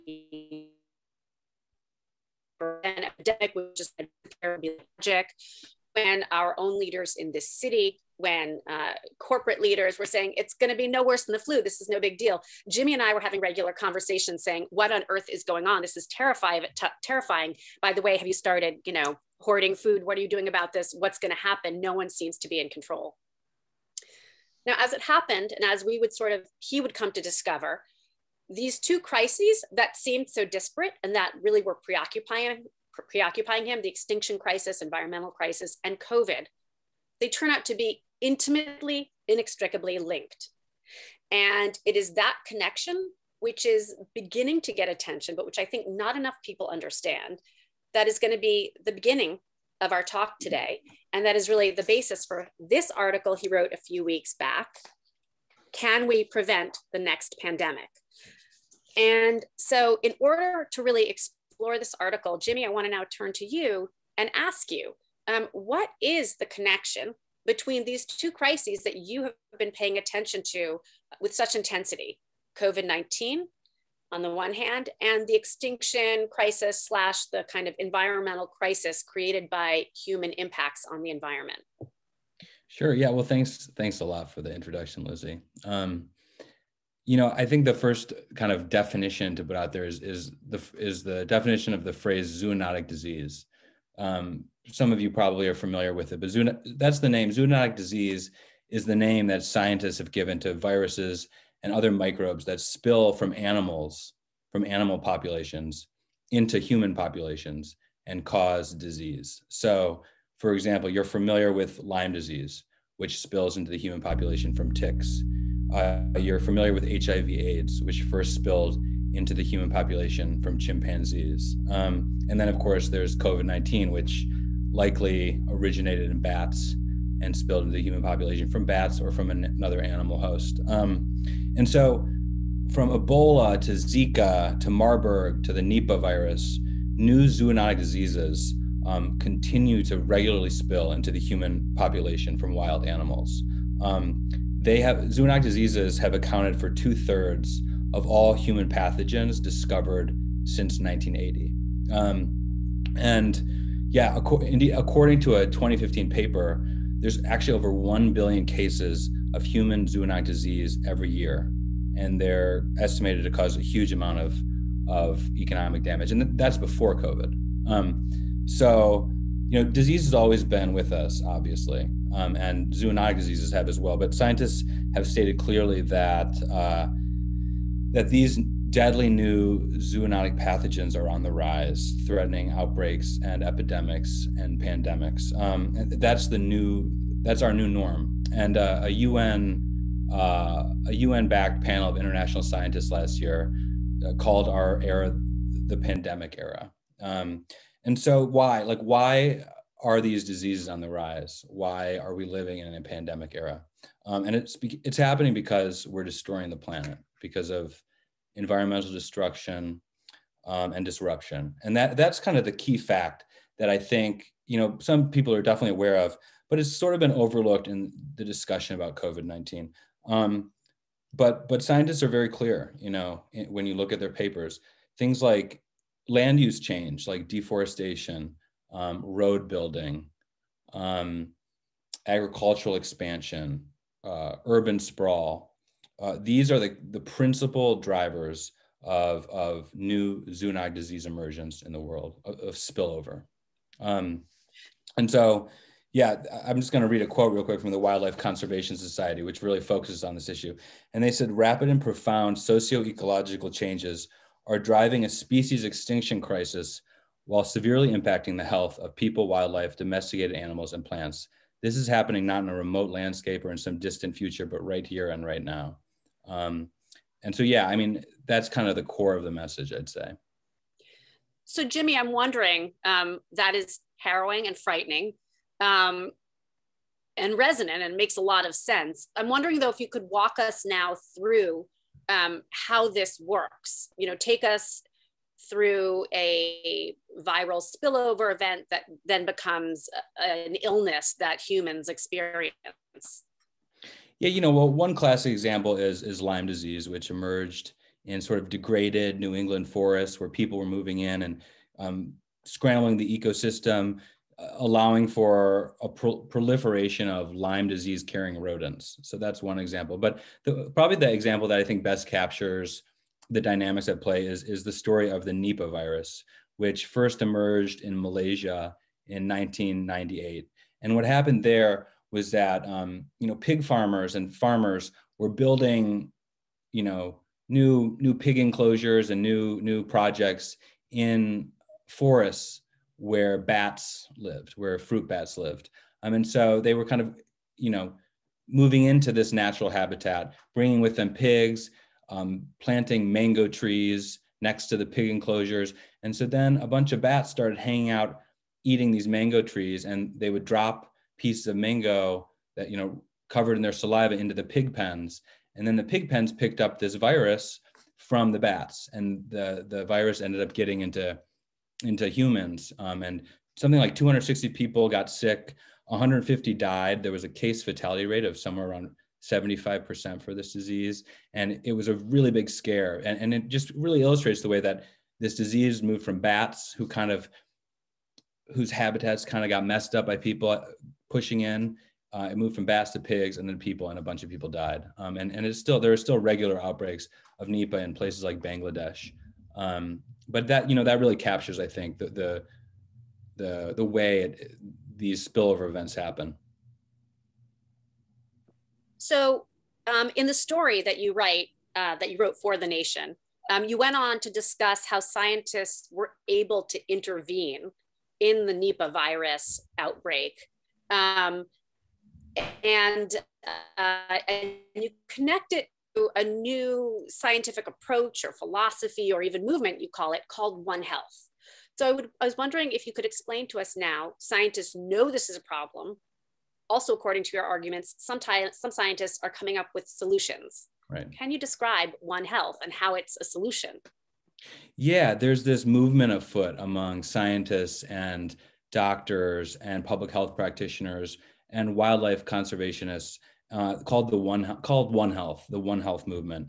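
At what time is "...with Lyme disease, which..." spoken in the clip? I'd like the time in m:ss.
1:51.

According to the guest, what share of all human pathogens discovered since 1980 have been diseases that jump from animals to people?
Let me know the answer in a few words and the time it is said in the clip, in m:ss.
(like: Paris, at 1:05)
two thirds, at 2:26.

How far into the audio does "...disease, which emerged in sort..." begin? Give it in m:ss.
4:56.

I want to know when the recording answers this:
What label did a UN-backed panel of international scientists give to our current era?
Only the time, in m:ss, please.
3:15.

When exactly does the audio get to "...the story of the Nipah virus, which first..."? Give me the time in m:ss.
5:14.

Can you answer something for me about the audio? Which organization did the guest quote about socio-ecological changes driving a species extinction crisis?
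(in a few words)
Wildlife Conservation Society.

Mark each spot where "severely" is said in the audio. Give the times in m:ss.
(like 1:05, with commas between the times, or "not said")
4:17.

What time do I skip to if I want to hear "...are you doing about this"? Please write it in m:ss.
0:20.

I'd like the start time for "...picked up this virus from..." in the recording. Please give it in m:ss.
5:56.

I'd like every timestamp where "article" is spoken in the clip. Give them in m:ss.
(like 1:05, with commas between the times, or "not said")
0:52, 1:01.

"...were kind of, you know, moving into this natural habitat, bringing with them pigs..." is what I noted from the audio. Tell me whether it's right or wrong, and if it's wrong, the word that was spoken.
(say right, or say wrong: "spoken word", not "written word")
right.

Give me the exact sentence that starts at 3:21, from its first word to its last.
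Why are we living in a pandemic era?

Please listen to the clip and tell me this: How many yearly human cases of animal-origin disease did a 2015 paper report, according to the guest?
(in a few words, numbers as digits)
over 1 billion.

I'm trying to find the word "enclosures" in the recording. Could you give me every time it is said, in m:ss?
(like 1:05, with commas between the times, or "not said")
5:28, 5:45.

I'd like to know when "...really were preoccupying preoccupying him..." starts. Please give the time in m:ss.
0:31.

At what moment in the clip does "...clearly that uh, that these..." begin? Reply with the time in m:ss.
2:55.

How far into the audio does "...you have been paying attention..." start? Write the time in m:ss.
1:08.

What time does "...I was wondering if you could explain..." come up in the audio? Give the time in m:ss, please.
7:02.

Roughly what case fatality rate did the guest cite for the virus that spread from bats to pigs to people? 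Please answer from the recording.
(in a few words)
75%.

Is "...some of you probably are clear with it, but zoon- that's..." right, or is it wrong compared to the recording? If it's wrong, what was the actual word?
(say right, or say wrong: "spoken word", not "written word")
wrong: "familiar", not "clear".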